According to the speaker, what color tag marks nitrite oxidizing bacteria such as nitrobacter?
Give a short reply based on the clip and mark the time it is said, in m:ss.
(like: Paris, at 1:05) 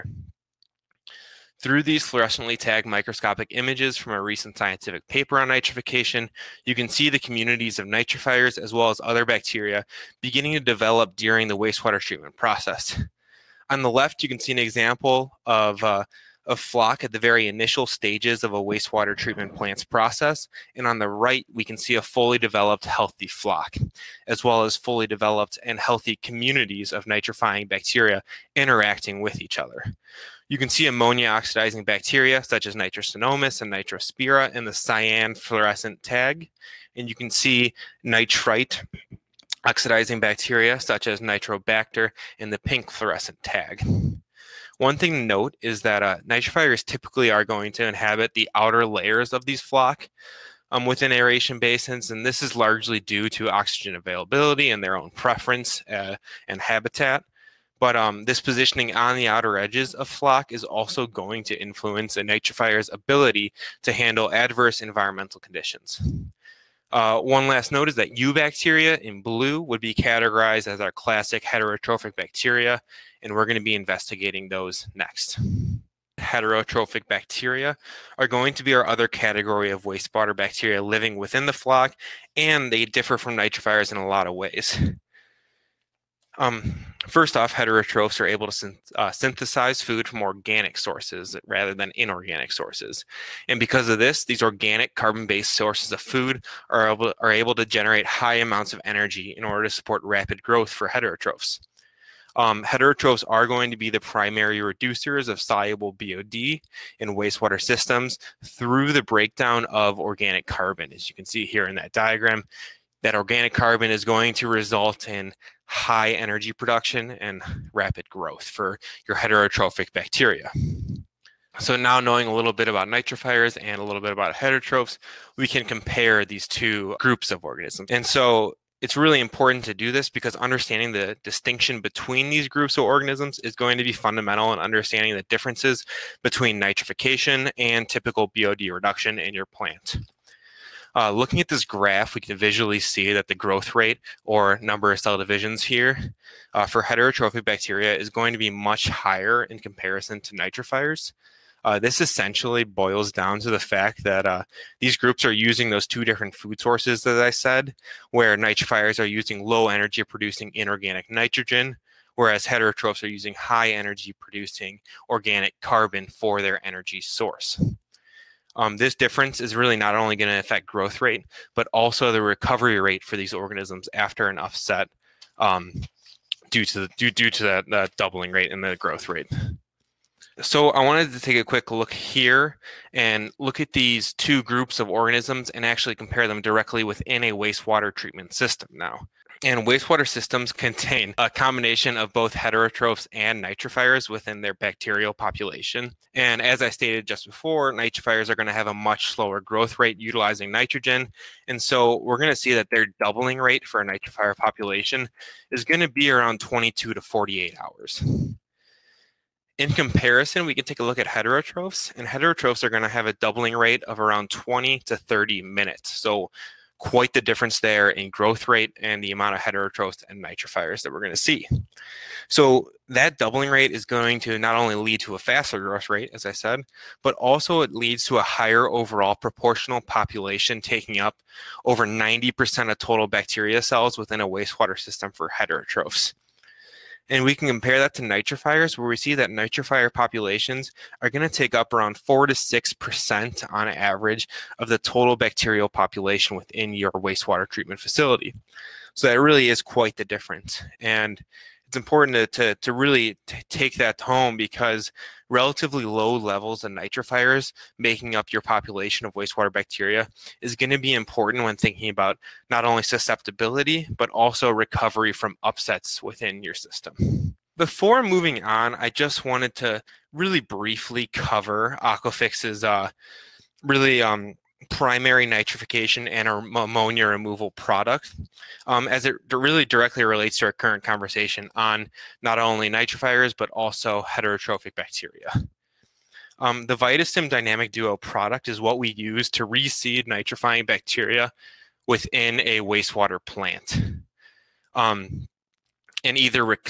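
Pink, at 0:42.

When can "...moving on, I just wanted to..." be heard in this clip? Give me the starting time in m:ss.
4:28.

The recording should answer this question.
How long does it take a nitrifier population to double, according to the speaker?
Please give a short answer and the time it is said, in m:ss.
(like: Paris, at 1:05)
22 to 48 hours, at 3:26.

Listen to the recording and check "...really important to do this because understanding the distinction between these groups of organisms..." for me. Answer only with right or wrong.
right.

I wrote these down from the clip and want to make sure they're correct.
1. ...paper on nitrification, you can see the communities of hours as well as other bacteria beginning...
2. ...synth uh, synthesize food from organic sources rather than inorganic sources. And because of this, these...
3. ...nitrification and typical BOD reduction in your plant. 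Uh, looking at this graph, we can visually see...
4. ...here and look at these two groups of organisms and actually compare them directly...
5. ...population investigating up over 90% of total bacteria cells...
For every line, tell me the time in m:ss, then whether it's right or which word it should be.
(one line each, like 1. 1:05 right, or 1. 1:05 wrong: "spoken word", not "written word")
1. 0:05 wrong: "nitrifiers", not "hours"
2. 1:28 right
3. 2:16 right
4. 3:01 right
5. 3:49 wrong: "taking", not "investigating".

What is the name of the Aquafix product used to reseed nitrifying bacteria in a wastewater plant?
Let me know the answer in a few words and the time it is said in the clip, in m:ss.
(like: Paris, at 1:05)
Vitastim Dynamic Duo, at 4:46.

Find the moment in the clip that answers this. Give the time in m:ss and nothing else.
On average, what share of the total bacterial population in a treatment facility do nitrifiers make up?
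4:01.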